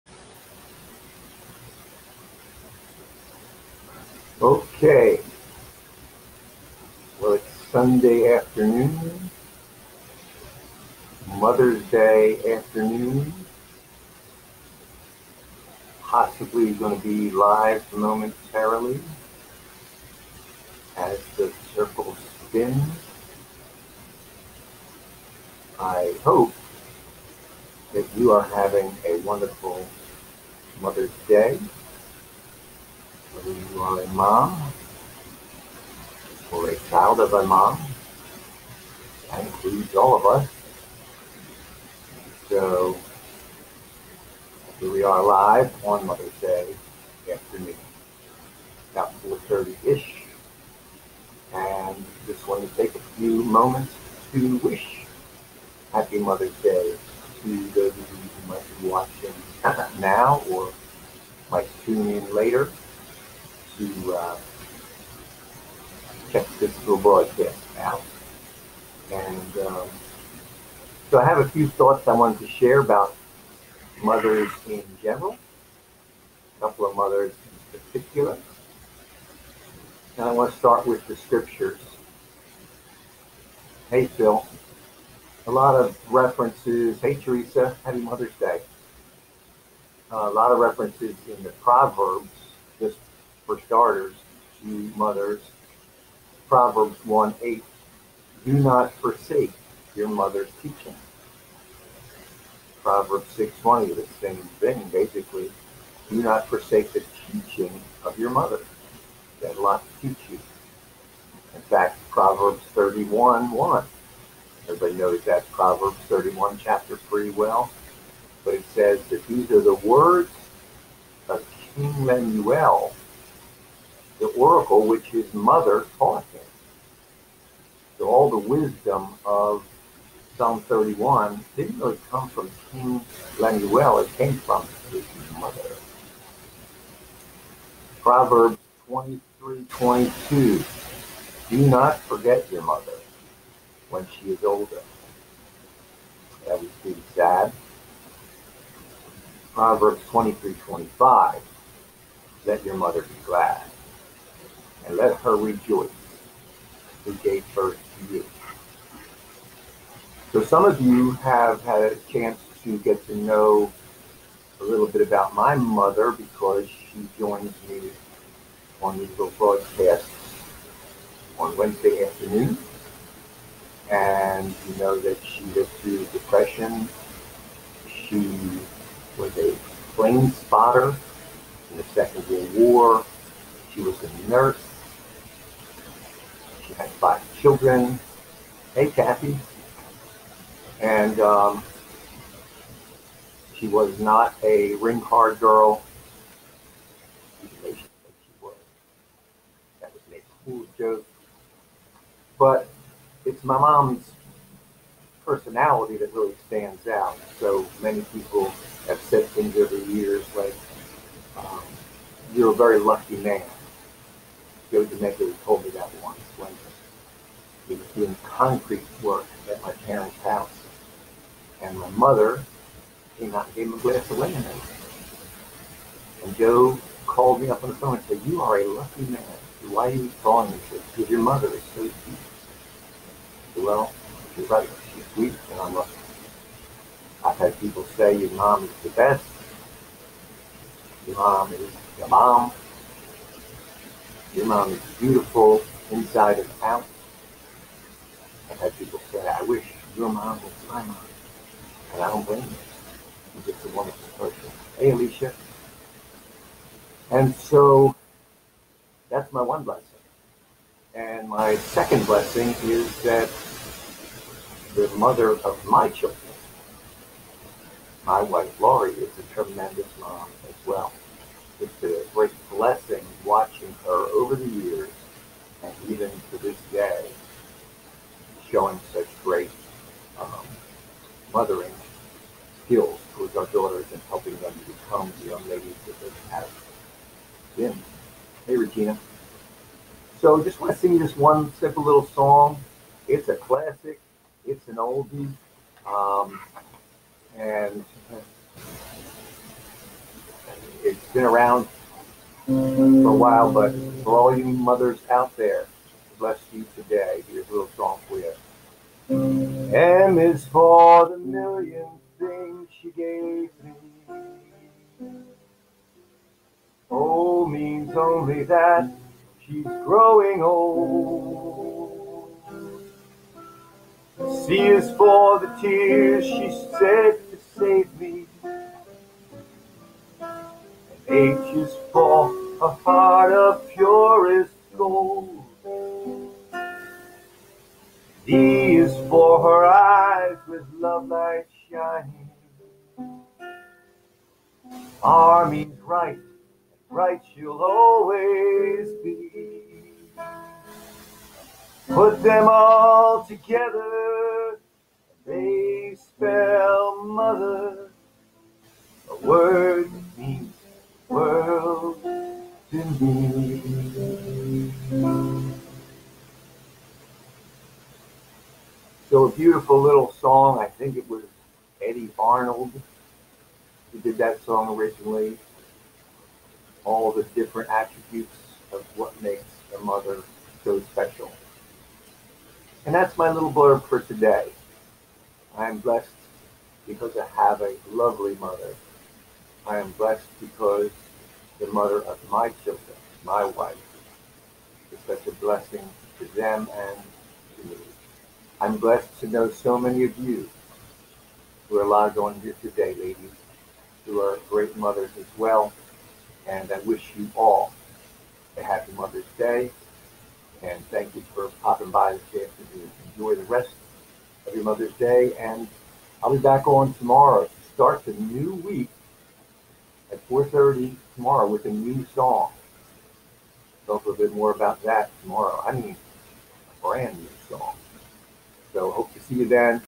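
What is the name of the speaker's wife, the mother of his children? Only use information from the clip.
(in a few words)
Laurie.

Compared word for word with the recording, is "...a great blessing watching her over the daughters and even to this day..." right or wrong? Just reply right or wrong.
wrong.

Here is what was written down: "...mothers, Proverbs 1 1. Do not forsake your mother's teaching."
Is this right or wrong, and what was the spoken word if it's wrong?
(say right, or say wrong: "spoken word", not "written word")
wrong: "8", not "1".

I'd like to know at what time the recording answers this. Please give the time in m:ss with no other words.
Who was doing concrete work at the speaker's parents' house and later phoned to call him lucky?
3:34.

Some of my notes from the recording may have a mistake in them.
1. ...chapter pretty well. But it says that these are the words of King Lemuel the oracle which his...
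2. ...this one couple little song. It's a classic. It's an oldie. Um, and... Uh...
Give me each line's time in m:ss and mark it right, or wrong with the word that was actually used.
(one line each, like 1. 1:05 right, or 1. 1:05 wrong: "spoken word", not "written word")
1. 1:56 right
2. 4:50 wrong: "simple", not "couple".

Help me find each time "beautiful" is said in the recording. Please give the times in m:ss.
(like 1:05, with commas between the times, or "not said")
4:04, 6:09.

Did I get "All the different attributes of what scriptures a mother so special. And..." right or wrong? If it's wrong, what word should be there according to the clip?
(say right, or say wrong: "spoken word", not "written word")
wrong: "makes", not "scriptures".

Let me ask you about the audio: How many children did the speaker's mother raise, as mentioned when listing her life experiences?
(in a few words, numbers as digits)
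5.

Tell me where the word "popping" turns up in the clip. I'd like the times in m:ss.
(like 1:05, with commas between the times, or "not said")
6:51.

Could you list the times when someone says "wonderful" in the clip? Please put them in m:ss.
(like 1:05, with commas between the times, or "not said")
0:29, 4:13.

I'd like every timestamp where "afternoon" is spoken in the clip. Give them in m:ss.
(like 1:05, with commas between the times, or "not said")
0:08, 0:12, 0:47, 2:52, 6:52.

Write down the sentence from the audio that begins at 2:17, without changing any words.
Proverbs 23:22, Do not forget your mother when she is older.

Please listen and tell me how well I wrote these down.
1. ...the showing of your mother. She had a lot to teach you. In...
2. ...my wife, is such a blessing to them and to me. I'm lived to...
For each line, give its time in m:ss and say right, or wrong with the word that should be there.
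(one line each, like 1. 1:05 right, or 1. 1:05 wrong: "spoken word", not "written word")
1. 1:46 wrong: "teaching", not "showing"
2. 6:33 wrong: "blessed", not "lived".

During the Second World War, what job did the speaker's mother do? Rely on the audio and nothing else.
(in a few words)
Plane spotter.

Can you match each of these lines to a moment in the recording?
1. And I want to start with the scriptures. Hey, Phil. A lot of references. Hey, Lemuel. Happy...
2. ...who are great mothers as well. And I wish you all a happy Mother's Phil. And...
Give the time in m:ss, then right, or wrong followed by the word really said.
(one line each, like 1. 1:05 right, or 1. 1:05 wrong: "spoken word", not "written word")
1. 1:20 wrong: "Teresa", not "Lemuel"
2. 6:44 wrong: "Day", not "Phil".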